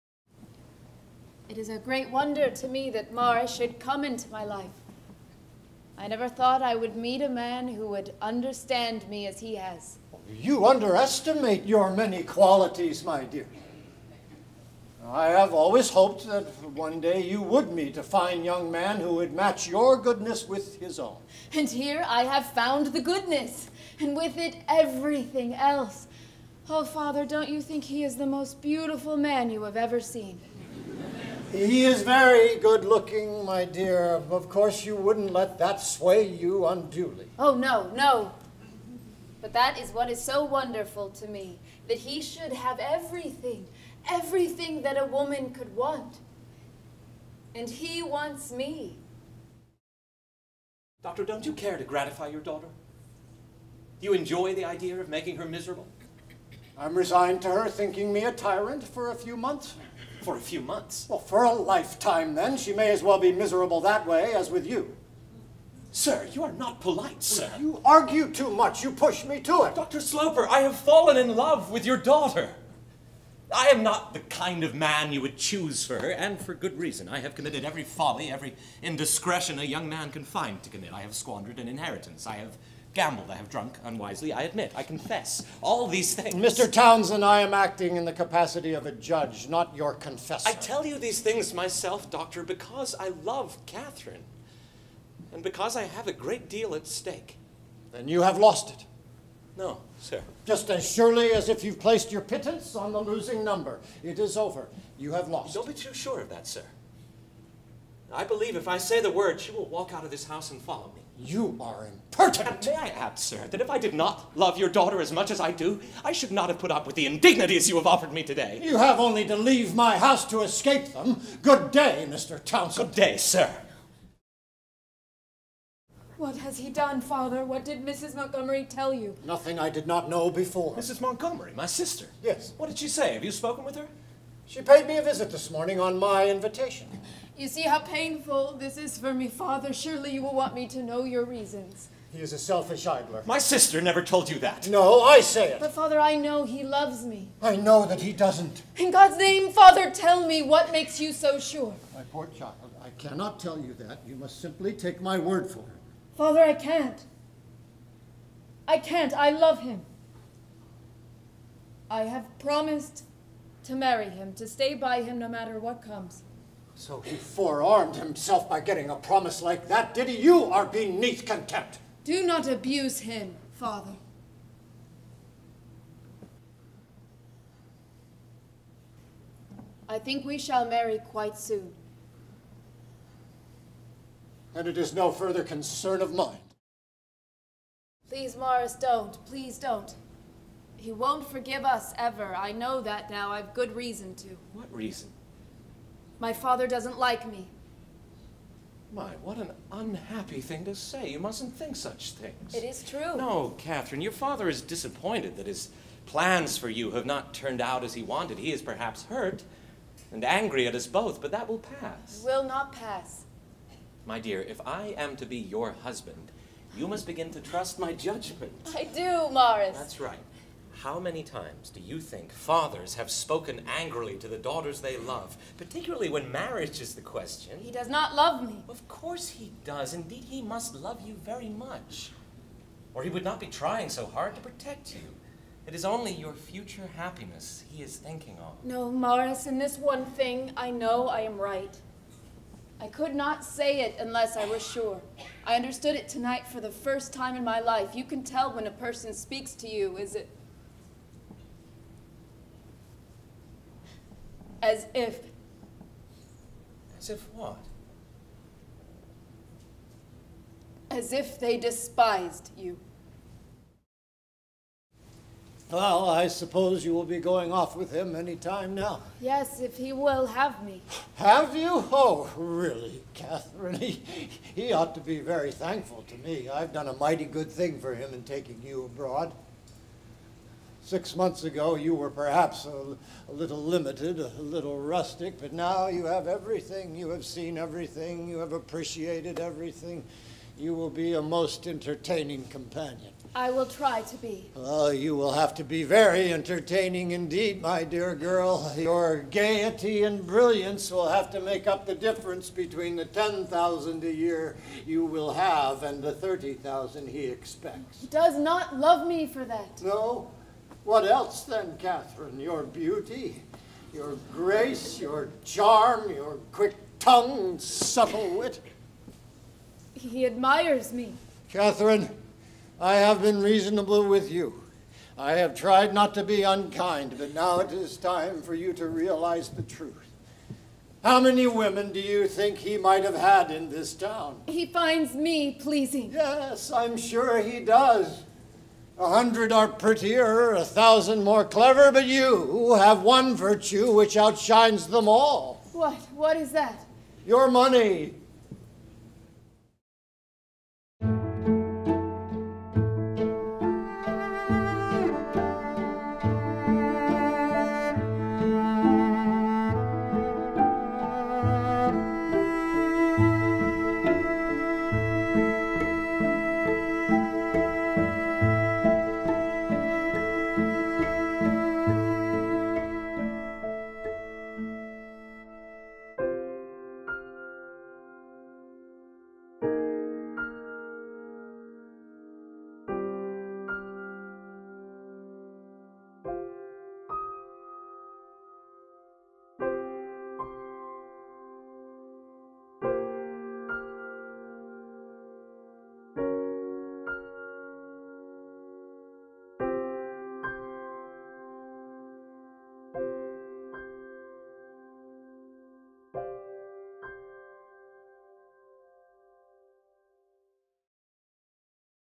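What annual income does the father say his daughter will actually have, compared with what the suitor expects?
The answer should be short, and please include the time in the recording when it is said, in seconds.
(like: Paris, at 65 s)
10,000 a year, at 303 s.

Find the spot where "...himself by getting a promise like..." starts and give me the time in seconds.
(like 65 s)
167 s.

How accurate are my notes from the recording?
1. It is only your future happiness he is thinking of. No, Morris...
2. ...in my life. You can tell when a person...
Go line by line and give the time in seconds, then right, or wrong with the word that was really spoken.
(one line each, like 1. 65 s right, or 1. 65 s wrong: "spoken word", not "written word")
1. 235 s right
2. 247 s right.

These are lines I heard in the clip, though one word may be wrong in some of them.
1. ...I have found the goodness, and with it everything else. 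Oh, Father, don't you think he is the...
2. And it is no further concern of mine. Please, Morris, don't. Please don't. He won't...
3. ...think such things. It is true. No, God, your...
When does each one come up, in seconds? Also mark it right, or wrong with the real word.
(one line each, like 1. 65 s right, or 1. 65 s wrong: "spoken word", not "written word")
1. 22 s right
2. 184 s right
3. 201 s wrong: "Catherine", not "God".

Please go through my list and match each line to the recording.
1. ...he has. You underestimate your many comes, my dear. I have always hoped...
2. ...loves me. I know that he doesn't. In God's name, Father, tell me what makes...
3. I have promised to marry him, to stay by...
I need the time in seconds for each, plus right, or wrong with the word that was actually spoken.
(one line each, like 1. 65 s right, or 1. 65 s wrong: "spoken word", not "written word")
1. 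9 s wrong: "qualities", not "comes"
2. 146 s right
3. 161 s right.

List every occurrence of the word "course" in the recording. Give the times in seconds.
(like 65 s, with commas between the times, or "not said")
34 s, 228 s.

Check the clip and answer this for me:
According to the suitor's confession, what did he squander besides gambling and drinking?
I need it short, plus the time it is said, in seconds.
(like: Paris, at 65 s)
An inheritance, at 81 s.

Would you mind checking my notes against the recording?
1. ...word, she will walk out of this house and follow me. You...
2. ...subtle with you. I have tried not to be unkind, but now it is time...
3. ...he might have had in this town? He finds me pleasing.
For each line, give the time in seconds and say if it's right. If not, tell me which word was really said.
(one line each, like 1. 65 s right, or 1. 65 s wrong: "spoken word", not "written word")
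1. 109 s right
2. 323 s wrong: "reasonable", not "subtle"
3. 332 s right.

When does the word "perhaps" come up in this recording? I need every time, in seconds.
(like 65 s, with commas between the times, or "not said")
208 s, 282 s.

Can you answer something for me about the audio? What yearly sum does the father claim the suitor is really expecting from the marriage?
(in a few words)
30,000.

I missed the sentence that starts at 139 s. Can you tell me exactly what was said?
Surely you will want me to know your reasons.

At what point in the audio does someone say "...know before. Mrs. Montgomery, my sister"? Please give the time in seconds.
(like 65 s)
130 s.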